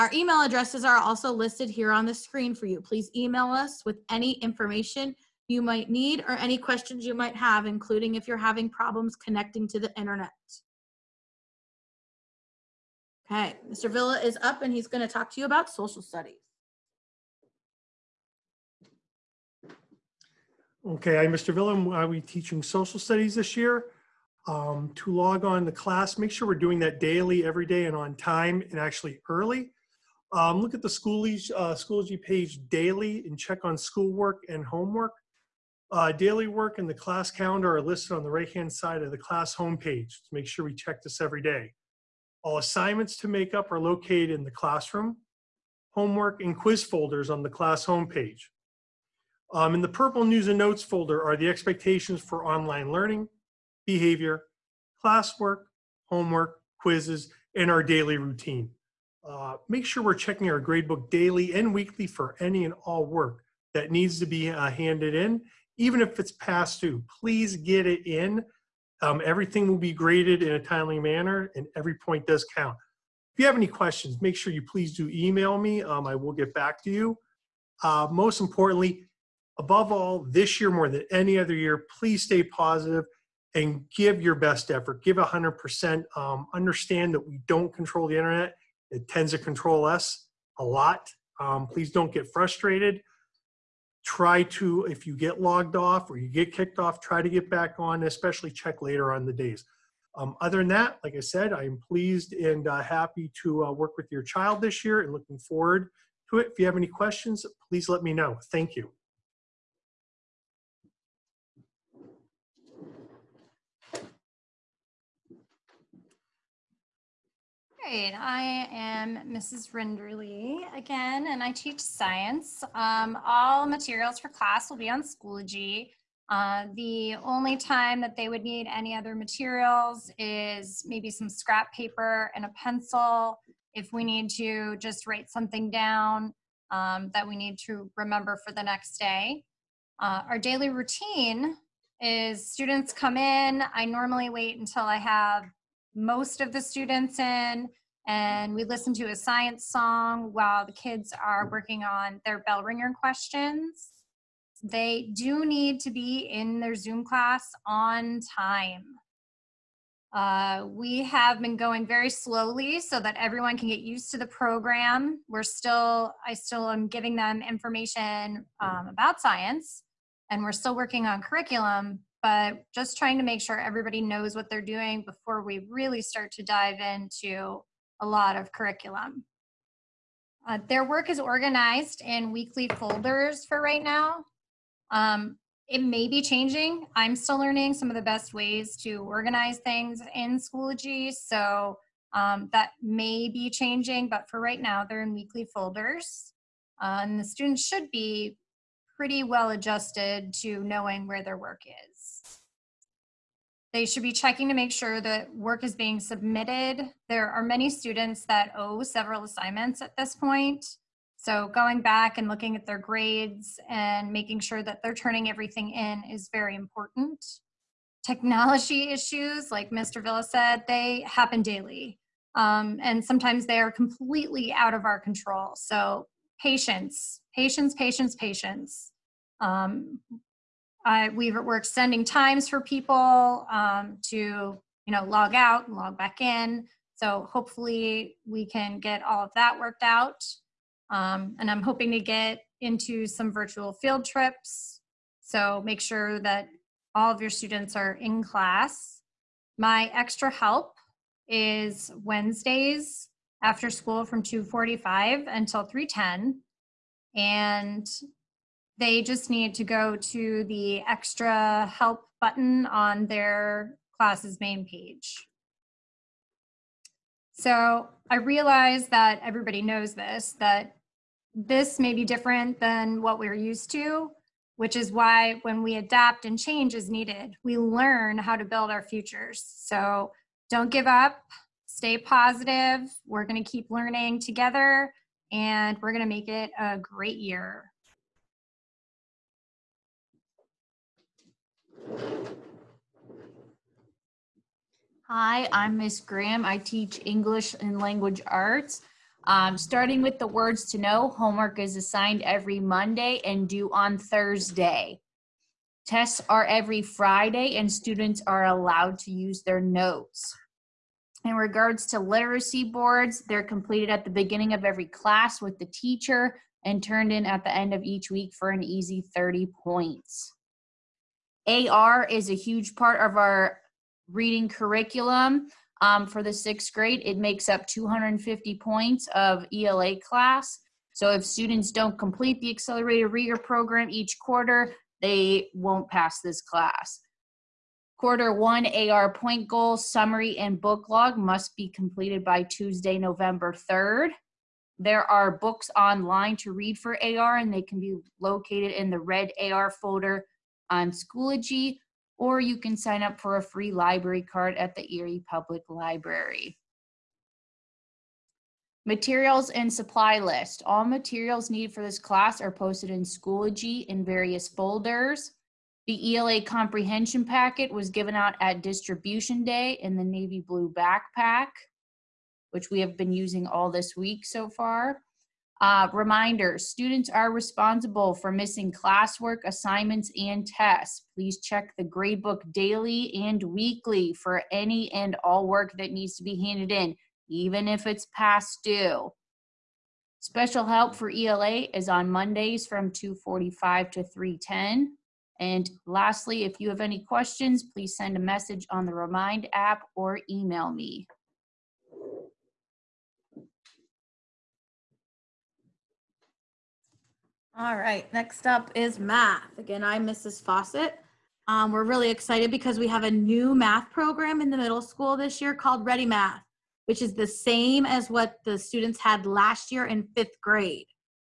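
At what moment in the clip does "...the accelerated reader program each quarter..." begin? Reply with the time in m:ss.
5:32.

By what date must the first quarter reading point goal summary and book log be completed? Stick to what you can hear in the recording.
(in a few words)
Tuesday, November 3rd.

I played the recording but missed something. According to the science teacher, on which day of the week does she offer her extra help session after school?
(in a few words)
Wednesdays.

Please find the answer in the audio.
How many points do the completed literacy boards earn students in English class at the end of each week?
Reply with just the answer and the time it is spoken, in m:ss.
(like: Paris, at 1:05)
30, at 5:19.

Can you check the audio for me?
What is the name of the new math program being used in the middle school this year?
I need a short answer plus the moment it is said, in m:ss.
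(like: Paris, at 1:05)
Ready Math, at 6:55.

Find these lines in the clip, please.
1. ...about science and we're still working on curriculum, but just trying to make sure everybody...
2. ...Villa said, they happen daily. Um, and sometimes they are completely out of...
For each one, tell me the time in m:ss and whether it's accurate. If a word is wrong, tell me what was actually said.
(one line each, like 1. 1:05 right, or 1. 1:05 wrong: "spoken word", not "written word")
1. 2:48 right
2. 3:40 right.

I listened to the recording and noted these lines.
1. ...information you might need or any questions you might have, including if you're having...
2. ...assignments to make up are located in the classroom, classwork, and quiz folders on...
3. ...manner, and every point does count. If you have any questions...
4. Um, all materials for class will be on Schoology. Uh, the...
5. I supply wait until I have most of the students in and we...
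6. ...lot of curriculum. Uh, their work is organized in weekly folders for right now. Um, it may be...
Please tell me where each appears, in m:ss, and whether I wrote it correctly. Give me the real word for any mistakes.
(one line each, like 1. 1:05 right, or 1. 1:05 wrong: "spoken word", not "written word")
1. 0:04 right
2. 0:42 wrong: "homework", not "classwork"
3. 1:10 right
4. 2:02 right
5. 2:23 wrong: "normally", not "supply"
6. 2:58 right.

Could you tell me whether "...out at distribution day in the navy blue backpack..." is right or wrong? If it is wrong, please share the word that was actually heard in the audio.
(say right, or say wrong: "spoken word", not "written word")
right.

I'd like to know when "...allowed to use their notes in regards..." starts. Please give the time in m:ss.
5:08.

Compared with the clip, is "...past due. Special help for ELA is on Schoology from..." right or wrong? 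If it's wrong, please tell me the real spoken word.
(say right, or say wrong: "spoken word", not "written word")
wrong: "Mondays", not "Schoology".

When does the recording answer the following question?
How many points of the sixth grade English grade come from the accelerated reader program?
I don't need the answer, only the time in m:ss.
5:27.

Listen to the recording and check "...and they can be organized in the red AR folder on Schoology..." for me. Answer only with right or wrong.
wrong.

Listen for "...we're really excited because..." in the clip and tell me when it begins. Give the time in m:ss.
6:51.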